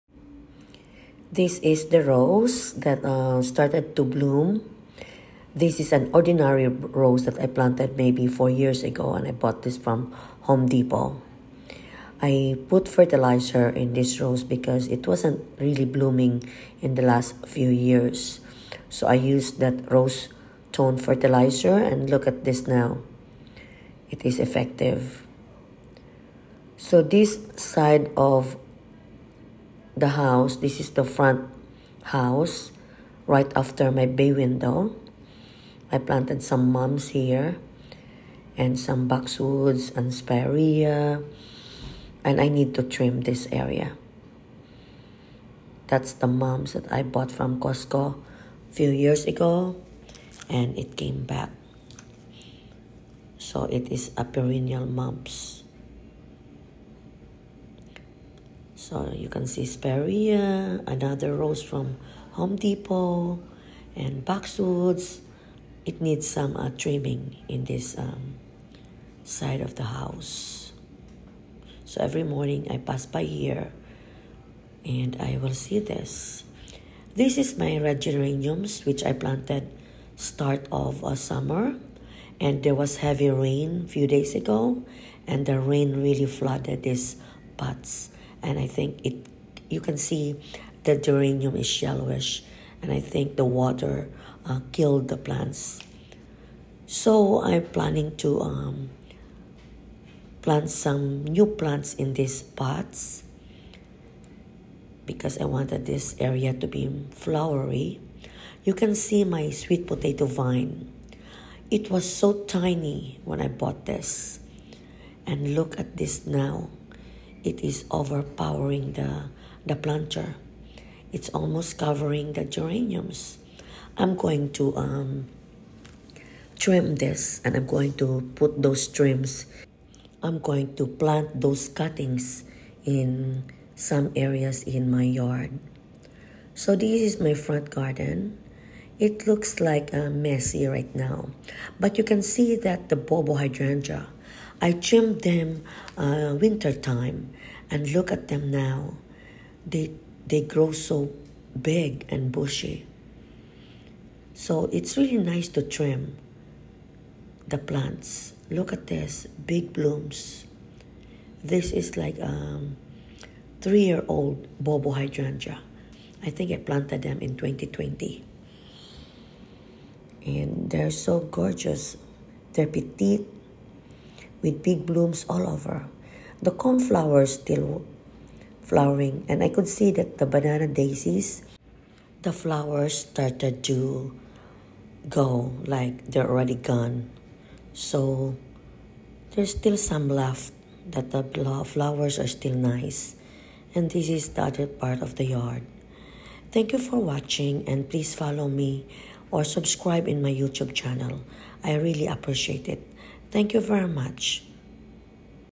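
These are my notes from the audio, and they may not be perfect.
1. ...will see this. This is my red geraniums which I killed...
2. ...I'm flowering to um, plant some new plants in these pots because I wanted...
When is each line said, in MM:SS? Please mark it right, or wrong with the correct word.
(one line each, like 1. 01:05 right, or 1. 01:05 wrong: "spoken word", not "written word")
1. 01:15 wrong: "planted", not "killed"
2. 01:37 wrong: "planning", not "flowering".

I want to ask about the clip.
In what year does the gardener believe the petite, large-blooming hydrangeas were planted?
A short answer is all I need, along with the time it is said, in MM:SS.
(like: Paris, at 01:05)
2020, at 02:47.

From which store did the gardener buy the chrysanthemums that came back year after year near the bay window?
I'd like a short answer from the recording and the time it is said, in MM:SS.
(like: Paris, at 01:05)
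Costco, at 00:47.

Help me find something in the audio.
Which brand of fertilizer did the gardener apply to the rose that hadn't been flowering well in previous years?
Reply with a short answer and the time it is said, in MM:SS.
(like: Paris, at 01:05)
Rose Tone, at 00:19.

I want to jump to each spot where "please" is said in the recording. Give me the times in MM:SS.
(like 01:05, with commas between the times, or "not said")
03:17.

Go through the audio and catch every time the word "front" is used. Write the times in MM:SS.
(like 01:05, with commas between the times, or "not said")
00:31, 02:17.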